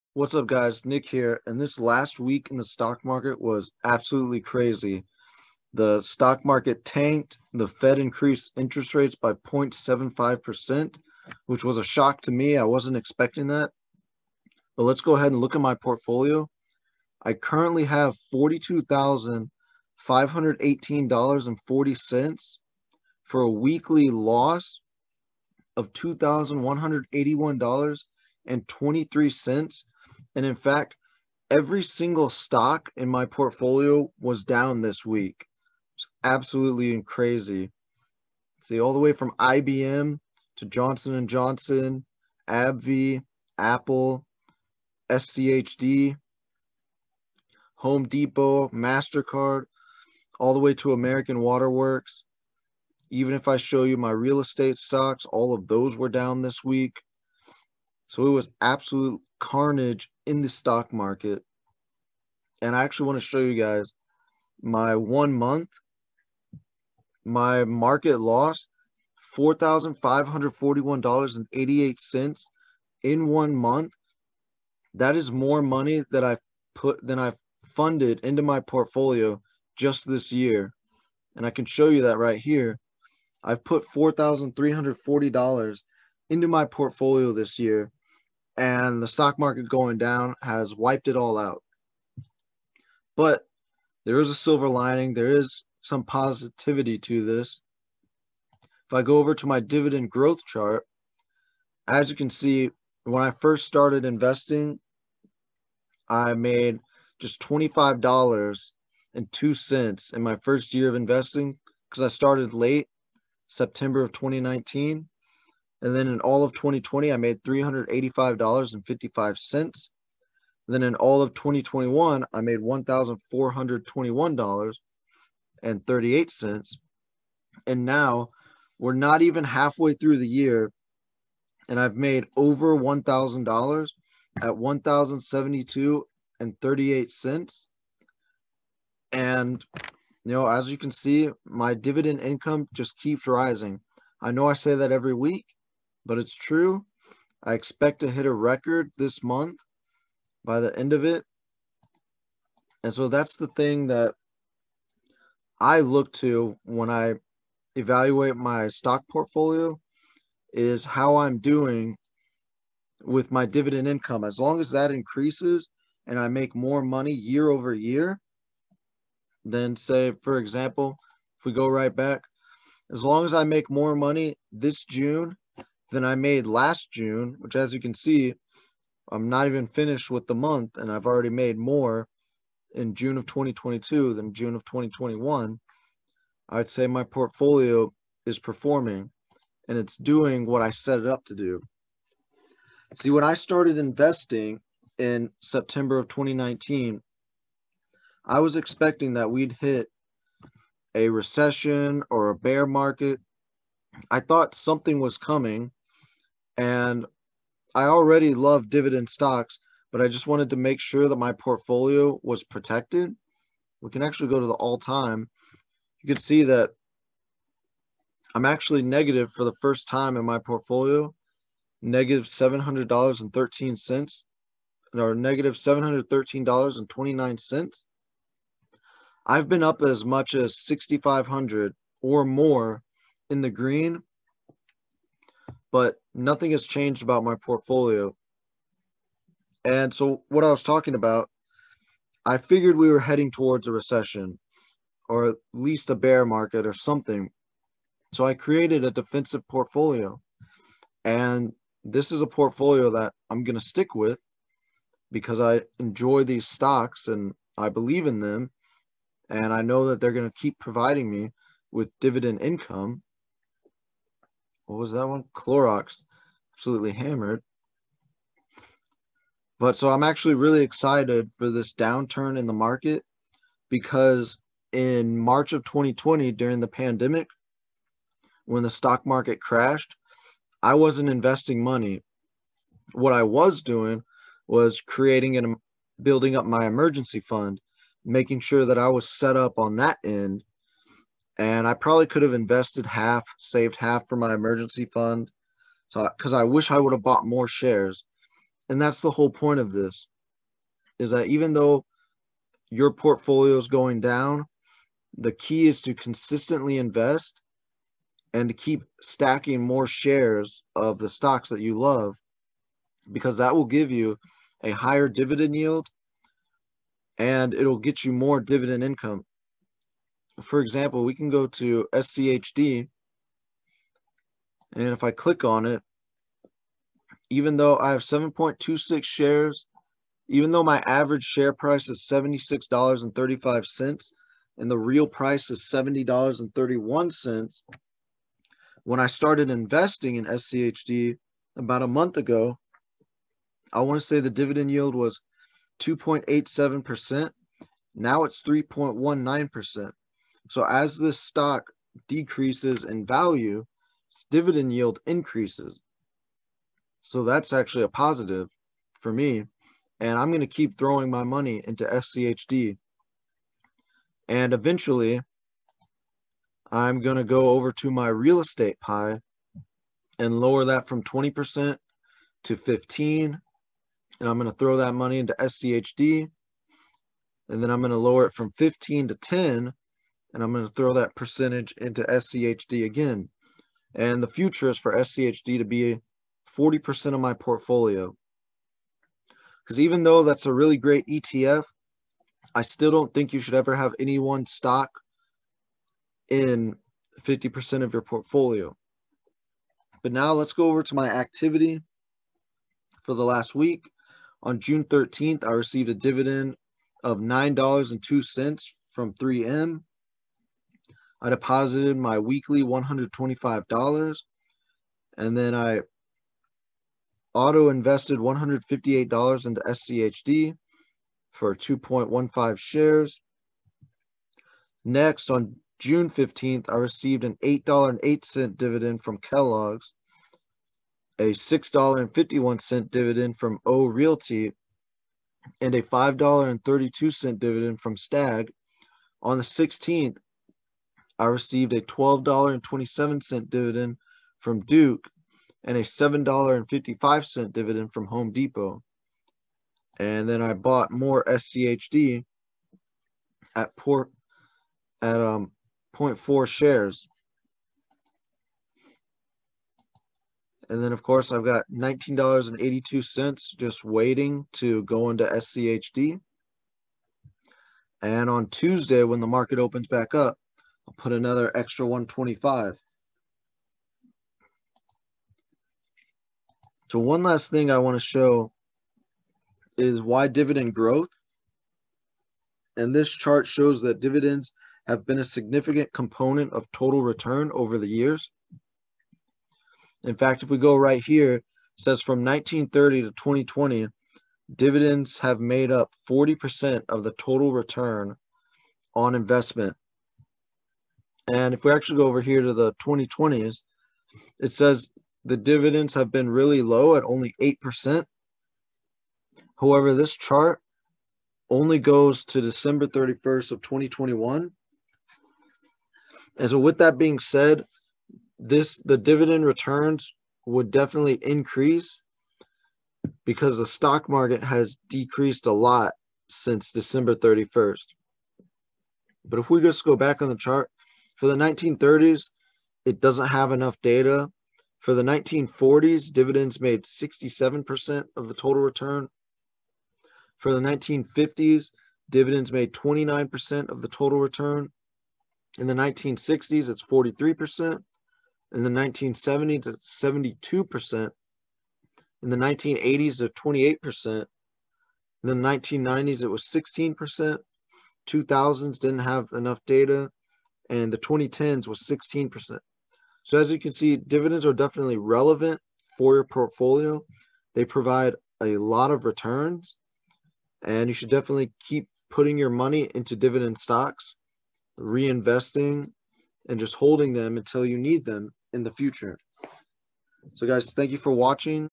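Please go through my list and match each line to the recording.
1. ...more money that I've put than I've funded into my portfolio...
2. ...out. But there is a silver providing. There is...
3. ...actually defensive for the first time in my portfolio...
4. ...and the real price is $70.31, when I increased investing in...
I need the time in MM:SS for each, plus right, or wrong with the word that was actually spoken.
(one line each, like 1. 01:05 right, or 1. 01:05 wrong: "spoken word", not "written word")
1. 01:15 right
2. 01:31 wrong: "lining", not "providing"
3. 03:38 wrong: "negative", not "defensive"
4. 05:34 wrong: "started", not "increased".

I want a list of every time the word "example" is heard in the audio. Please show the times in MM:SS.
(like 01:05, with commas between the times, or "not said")
02:50, 05:20.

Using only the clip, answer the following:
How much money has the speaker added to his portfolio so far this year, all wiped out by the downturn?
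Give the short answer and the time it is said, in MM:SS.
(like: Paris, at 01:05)
$4,340, at 01:23.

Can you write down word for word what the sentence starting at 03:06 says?
I'd say my portfolio is performing and it's doing what I set it up to do.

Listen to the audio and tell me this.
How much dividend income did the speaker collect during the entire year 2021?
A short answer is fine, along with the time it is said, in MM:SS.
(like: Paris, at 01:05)
$1,421.38, at 02:02.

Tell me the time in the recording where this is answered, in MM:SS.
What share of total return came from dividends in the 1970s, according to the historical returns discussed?
09:10.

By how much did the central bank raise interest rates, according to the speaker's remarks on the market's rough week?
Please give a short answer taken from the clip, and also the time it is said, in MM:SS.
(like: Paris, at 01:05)
0.75%, at 00:09.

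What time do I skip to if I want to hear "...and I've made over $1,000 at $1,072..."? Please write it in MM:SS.
02:11.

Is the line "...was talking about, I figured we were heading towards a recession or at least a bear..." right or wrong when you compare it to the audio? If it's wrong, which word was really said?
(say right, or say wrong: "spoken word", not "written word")
right.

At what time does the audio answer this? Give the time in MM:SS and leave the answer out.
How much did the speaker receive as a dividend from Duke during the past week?
07:21.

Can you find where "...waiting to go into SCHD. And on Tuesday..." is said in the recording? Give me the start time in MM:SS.
07:43.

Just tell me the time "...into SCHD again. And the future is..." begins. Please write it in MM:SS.
06:21.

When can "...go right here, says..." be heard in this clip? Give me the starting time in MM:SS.
08:10.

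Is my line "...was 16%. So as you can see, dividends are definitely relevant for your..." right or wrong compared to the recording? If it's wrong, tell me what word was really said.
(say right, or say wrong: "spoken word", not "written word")
right.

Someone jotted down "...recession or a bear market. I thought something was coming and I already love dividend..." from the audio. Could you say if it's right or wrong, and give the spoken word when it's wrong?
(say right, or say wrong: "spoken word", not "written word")
right.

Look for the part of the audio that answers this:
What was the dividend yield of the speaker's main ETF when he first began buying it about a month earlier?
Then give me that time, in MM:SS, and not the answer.
05:45.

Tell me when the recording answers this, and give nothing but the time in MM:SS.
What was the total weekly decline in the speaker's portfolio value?
00:25.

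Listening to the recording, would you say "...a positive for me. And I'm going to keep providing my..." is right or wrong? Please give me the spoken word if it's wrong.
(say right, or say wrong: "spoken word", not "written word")
wrong: "throwing", not "providing".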